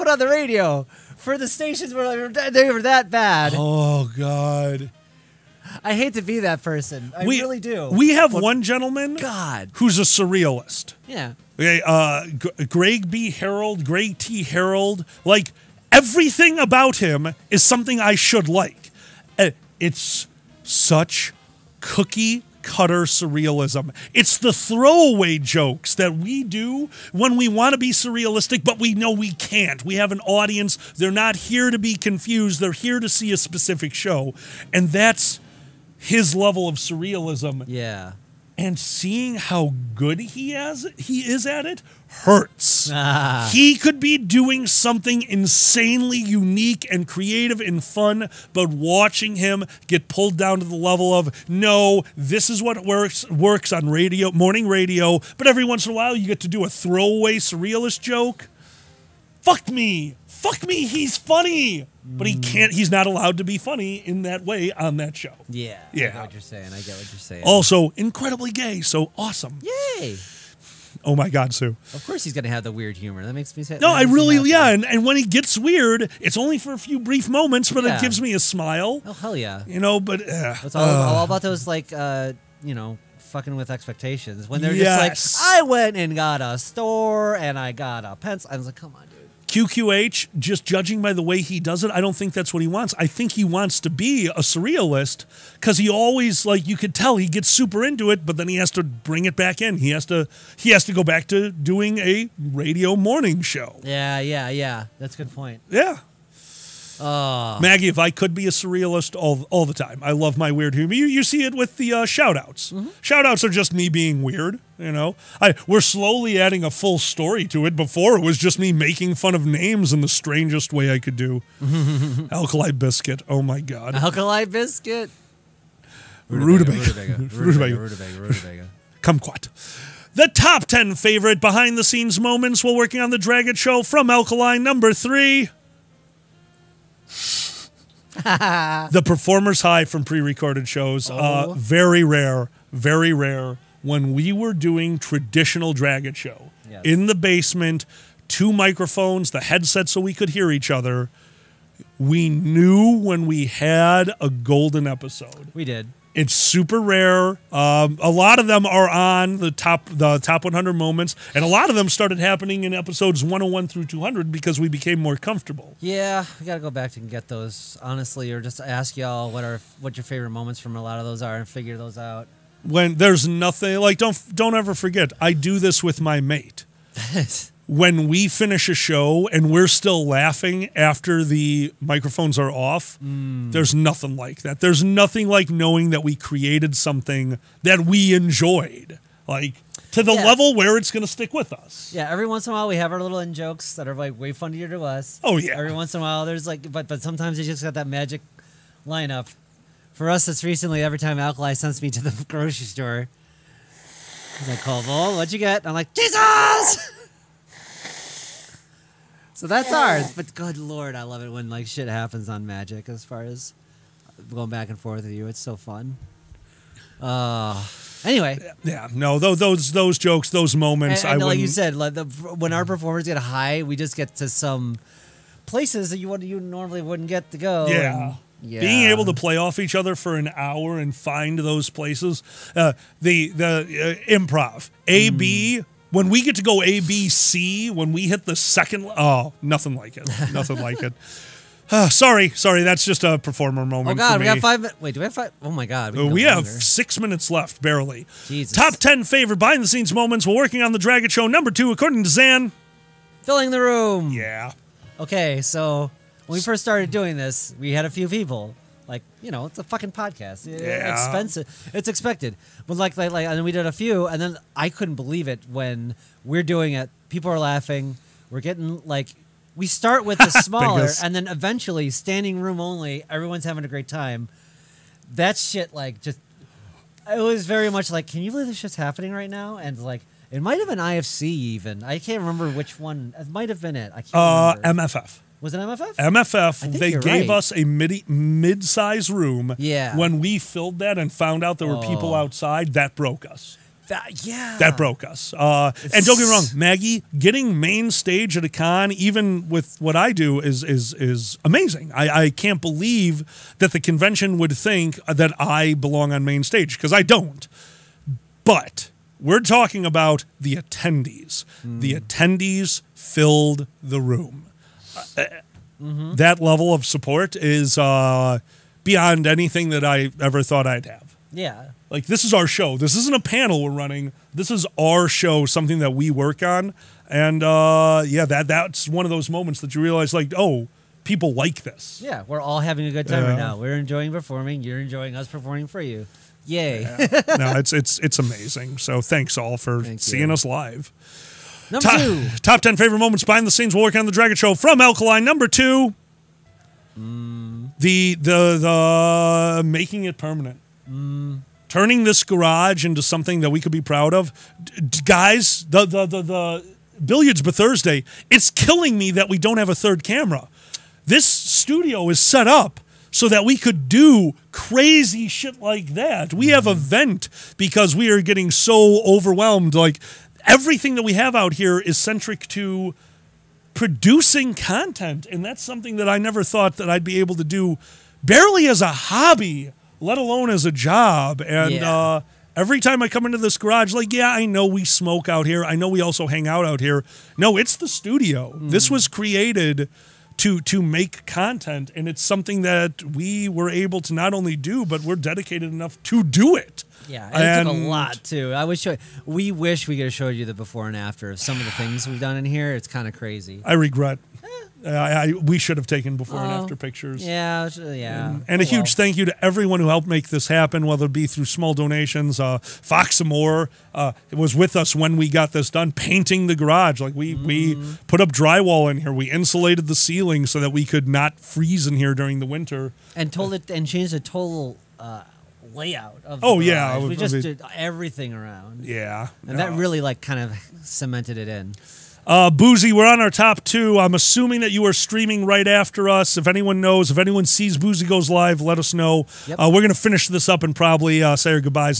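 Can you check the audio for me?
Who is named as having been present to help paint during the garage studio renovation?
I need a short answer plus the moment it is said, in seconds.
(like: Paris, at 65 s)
Fox Moore, at 412 s.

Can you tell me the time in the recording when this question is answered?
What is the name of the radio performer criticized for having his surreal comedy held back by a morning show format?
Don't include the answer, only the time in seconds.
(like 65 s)
13 s.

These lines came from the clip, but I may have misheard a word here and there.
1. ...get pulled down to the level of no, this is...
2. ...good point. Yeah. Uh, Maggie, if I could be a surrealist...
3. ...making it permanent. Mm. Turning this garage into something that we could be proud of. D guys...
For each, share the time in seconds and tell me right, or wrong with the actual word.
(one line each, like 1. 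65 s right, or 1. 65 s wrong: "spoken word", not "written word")
1. 49 s right
2. 105 s right
3. 349 s right.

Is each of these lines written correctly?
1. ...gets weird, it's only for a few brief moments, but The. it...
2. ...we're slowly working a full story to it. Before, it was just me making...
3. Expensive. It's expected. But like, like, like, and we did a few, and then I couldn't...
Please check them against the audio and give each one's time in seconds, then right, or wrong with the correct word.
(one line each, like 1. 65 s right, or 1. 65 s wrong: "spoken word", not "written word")
1. 75 s wrong: "Yeah", not "The"
2. 115 s wrong: "adding", not "working"
3. 260 s right.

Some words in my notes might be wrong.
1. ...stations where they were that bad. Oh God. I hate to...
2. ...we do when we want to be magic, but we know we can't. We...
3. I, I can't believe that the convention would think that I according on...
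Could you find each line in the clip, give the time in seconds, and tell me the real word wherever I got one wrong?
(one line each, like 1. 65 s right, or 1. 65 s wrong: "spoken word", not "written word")
1. 1 s right
2. 26 s wrong: "surrealistic", not "magic"
3. 301 s wrong: "belong", not "according".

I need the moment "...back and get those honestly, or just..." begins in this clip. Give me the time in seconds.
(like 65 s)
166 s.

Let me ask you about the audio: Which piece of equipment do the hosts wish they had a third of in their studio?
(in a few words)
camera.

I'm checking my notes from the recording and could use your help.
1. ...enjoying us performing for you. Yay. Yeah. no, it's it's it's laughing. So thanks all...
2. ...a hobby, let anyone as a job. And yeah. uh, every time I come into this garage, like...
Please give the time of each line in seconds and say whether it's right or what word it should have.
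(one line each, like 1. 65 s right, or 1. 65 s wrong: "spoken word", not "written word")
1. 334 s wrong: "amazing", not "laughing"
2. 378 s wrong: "alone", not "anyone".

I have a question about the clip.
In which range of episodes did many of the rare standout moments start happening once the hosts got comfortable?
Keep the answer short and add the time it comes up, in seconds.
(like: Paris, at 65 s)
101 through 200, at 163 s.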